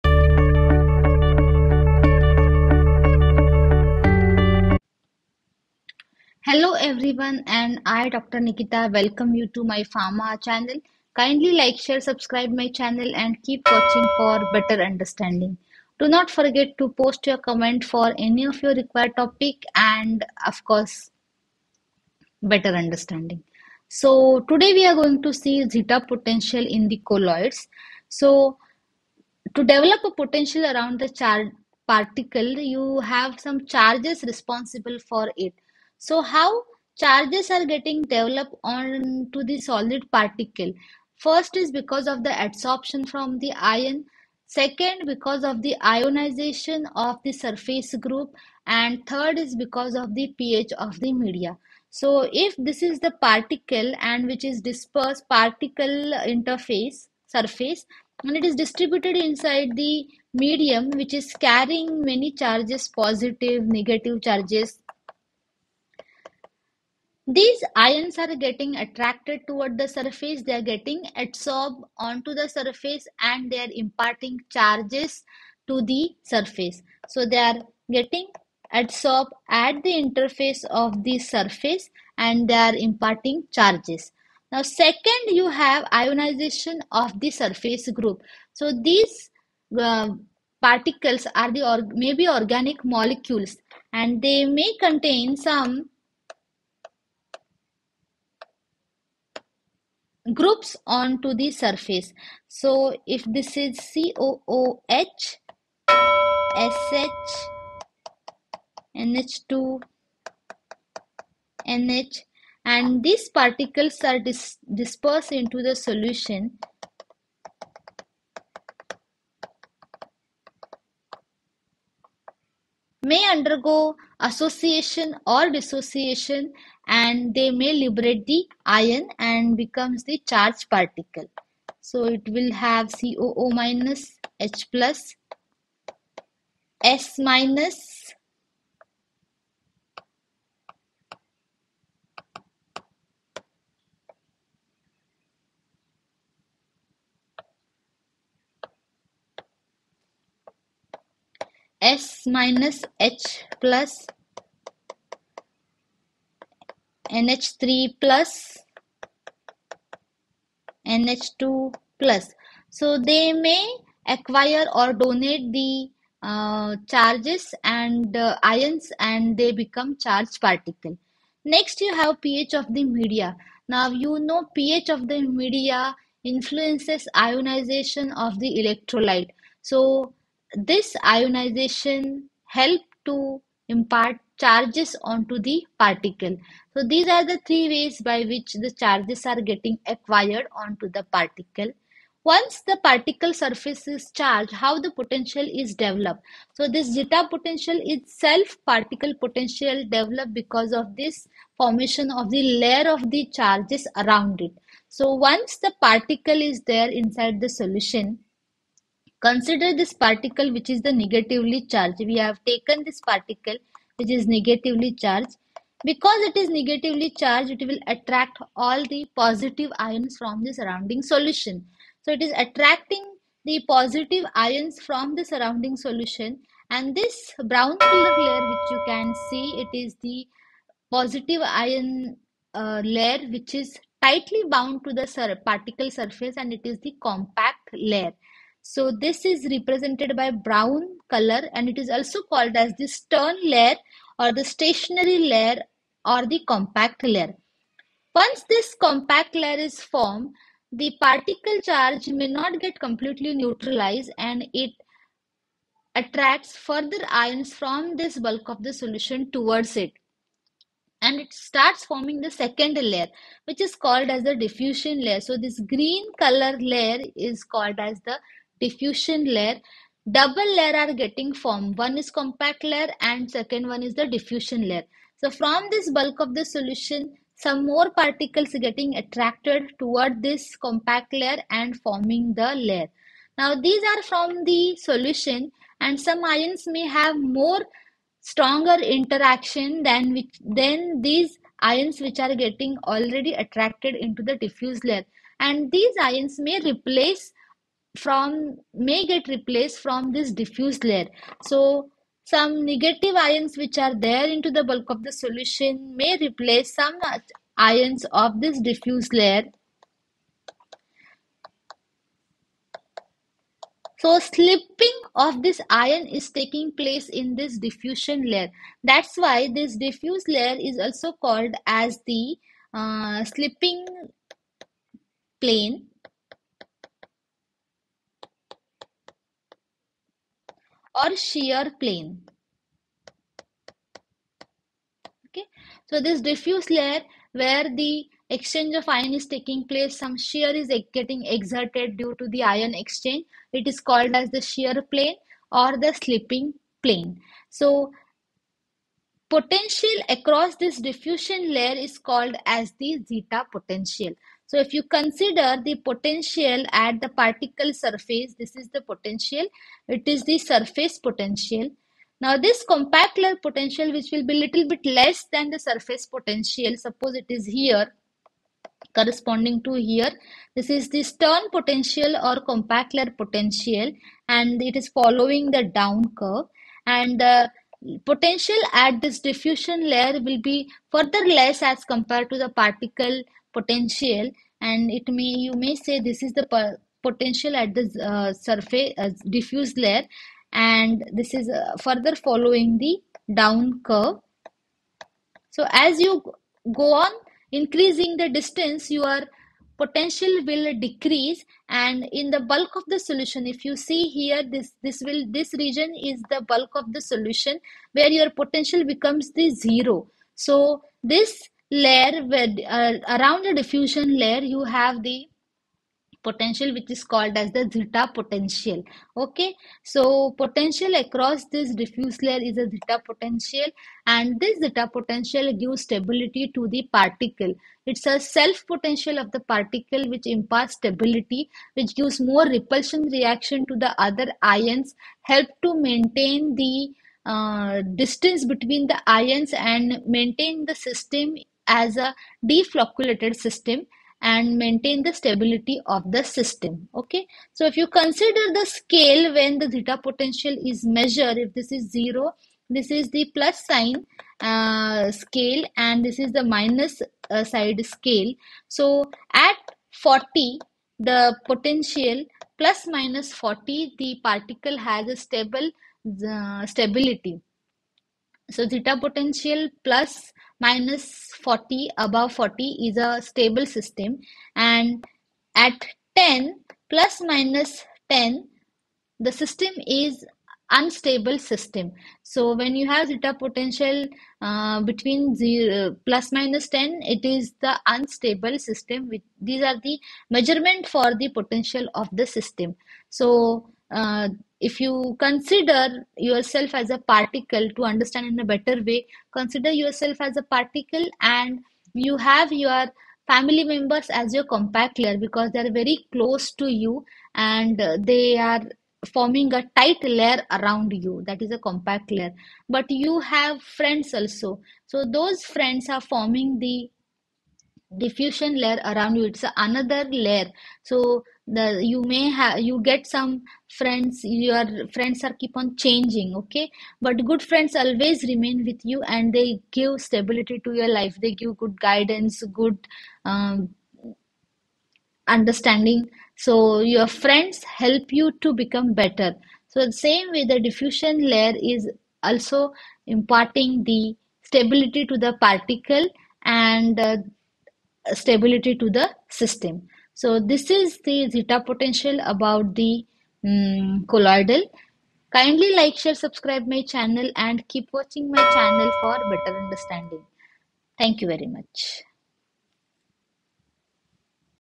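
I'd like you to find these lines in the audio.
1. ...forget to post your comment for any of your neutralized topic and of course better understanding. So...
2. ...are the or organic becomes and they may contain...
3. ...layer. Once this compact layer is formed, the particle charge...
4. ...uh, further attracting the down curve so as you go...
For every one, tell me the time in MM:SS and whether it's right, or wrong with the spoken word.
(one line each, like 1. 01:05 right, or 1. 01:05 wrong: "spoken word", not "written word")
1. 00:16 wrong: "required", not "neutralized"
2. 01:31 wrong: "molecules", not "becomes"
3. 04:07 right
4. 06:31 wrong: "following", not "attracting".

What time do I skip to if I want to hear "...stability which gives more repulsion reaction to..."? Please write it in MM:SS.
07:10.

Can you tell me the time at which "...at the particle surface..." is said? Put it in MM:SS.
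05:56.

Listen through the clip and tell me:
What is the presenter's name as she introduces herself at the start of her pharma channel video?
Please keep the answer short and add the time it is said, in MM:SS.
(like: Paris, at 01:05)
Dr. Nikita, at 00:08.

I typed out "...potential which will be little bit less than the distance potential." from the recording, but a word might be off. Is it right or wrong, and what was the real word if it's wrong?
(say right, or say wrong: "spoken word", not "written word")
wrong: "surface", not "distance".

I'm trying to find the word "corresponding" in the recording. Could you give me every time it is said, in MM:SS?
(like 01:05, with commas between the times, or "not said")
06:08.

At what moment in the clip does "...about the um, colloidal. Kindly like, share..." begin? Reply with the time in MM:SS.
09:12.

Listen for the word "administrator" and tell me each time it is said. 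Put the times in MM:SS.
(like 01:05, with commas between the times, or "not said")
not said.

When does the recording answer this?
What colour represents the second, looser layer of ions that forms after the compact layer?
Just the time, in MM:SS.
04:25.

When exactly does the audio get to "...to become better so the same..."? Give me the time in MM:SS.
08:58.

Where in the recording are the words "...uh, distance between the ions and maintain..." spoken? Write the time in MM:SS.
07:17.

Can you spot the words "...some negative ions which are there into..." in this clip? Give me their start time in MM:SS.
05:02.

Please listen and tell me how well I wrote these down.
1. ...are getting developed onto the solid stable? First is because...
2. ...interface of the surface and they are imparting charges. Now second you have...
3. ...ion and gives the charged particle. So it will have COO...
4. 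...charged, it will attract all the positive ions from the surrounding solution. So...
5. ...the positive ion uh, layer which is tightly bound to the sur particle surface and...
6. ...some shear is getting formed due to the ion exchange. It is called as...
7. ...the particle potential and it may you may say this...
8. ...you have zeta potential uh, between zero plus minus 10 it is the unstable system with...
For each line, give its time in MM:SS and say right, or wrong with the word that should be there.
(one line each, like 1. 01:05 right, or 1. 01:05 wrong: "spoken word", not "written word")
1. 00:37 wrong: "particle", not "stable"
2. 01:19 right
3. 02:08 wrong: "becomes", not "gives"
4. 03:37 right
5. 03:50 right
6. 05:39 wrong: "exerted", not "formed"
7. 06:22 right
8. 08:02 right.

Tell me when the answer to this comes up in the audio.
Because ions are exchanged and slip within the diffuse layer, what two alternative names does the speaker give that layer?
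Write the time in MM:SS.
05:23.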